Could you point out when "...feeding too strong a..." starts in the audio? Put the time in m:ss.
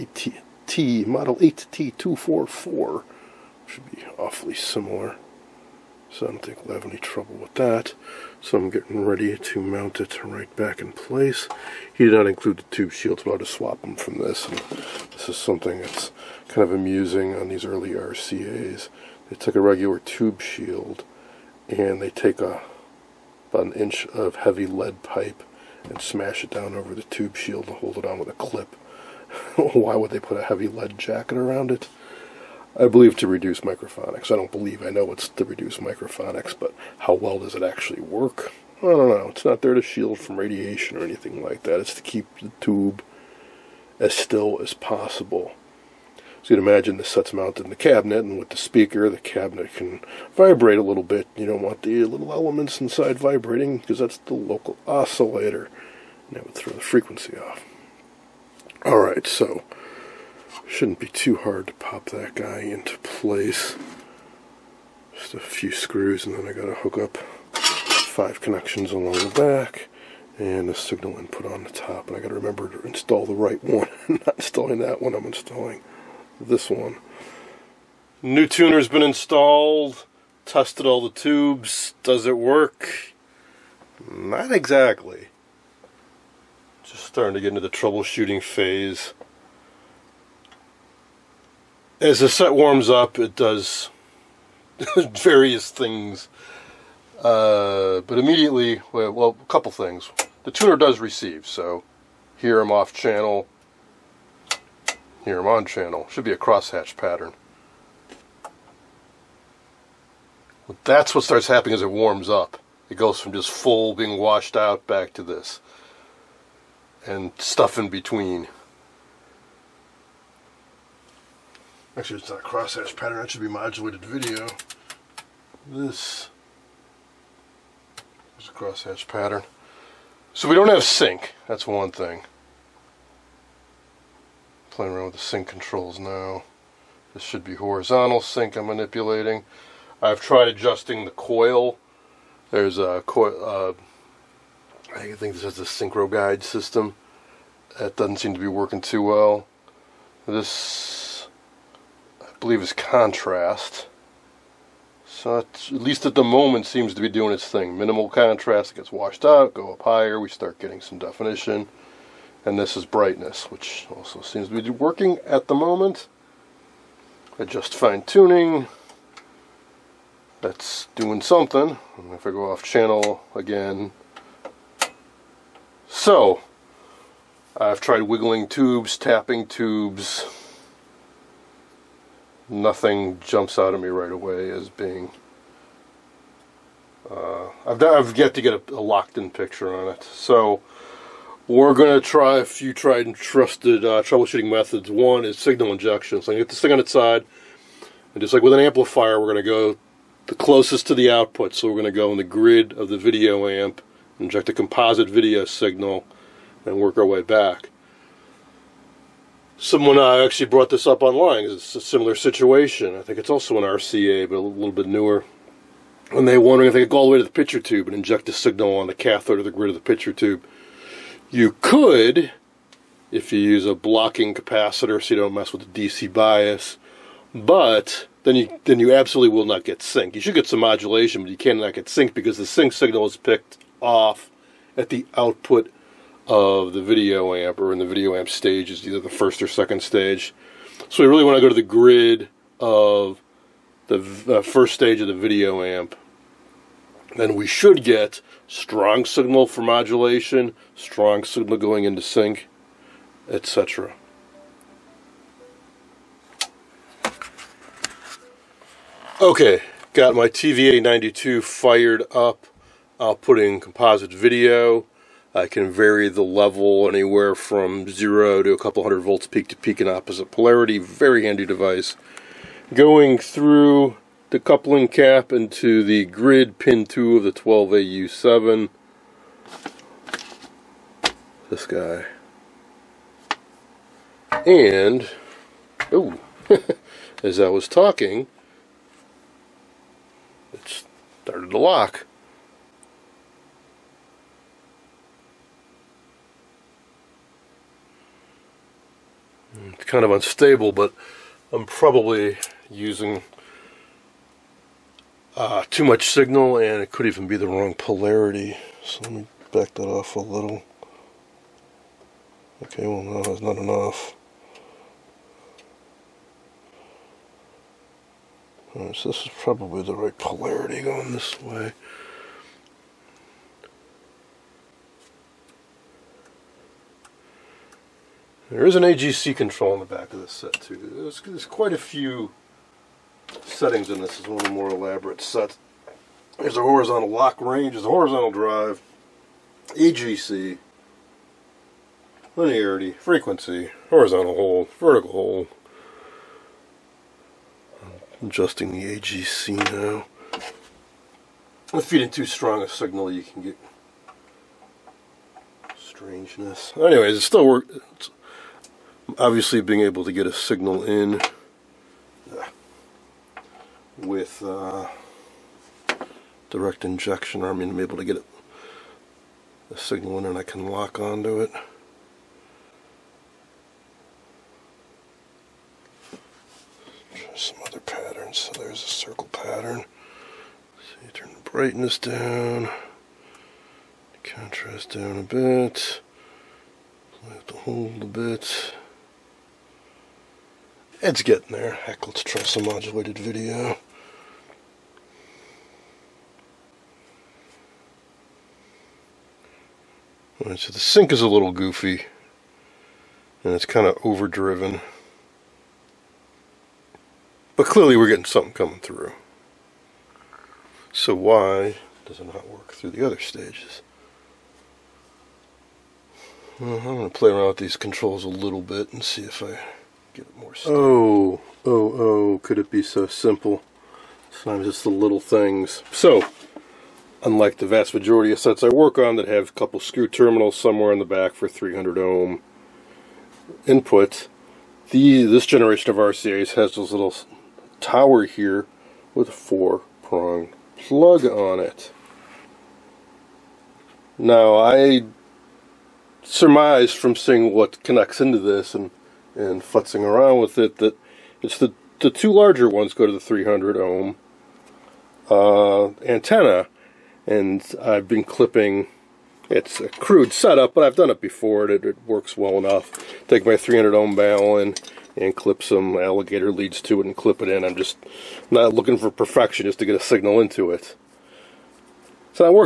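5:51.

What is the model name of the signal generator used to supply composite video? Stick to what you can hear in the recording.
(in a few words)
TVA92.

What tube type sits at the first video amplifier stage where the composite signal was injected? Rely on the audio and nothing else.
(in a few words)
12AU7.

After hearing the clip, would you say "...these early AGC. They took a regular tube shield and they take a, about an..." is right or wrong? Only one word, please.
wrong.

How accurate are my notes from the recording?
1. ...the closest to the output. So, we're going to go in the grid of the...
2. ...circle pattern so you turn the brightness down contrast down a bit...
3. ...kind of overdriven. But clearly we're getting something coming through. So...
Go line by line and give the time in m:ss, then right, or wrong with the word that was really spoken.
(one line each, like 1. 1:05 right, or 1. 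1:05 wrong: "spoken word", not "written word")
1. 3:20 right
2. 6:18 right
3. 6:43 right.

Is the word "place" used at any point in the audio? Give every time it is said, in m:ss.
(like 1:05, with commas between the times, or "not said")
0:10, 1:02.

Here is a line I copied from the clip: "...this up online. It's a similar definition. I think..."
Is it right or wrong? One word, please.
wrong.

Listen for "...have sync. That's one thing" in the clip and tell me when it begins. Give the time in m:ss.
2:10.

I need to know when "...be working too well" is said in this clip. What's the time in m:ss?
2:28.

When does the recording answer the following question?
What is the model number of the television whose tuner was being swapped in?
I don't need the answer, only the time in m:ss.
0:01.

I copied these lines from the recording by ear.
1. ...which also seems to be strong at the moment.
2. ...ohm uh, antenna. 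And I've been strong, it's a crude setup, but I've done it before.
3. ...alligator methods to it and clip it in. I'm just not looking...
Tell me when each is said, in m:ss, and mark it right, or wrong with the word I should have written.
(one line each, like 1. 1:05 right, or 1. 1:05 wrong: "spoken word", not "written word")
1. 2:43 wrong: "working", not "strong"
2. 7:33 wrong: "clipping", not "strong"
3. 7:45 wrong: "leads", not "methods".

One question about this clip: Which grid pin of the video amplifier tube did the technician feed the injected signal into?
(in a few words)
pin 2.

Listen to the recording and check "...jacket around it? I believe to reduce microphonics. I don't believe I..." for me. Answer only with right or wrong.
right.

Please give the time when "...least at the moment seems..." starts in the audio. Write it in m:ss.
2:35.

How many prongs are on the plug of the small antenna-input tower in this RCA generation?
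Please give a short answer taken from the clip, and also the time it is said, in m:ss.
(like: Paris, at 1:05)
4, at 7:19.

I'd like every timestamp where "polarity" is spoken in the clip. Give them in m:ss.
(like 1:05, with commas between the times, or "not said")
4:30, 5:07, 5:20.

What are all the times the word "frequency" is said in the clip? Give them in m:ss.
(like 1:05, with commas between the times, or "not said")
0:56, 5:42.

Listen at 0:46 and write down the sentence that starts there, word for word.
So you can imagine this set's mounted in the cabinet, and with the speaker, the cabinet can vibrate a little bit.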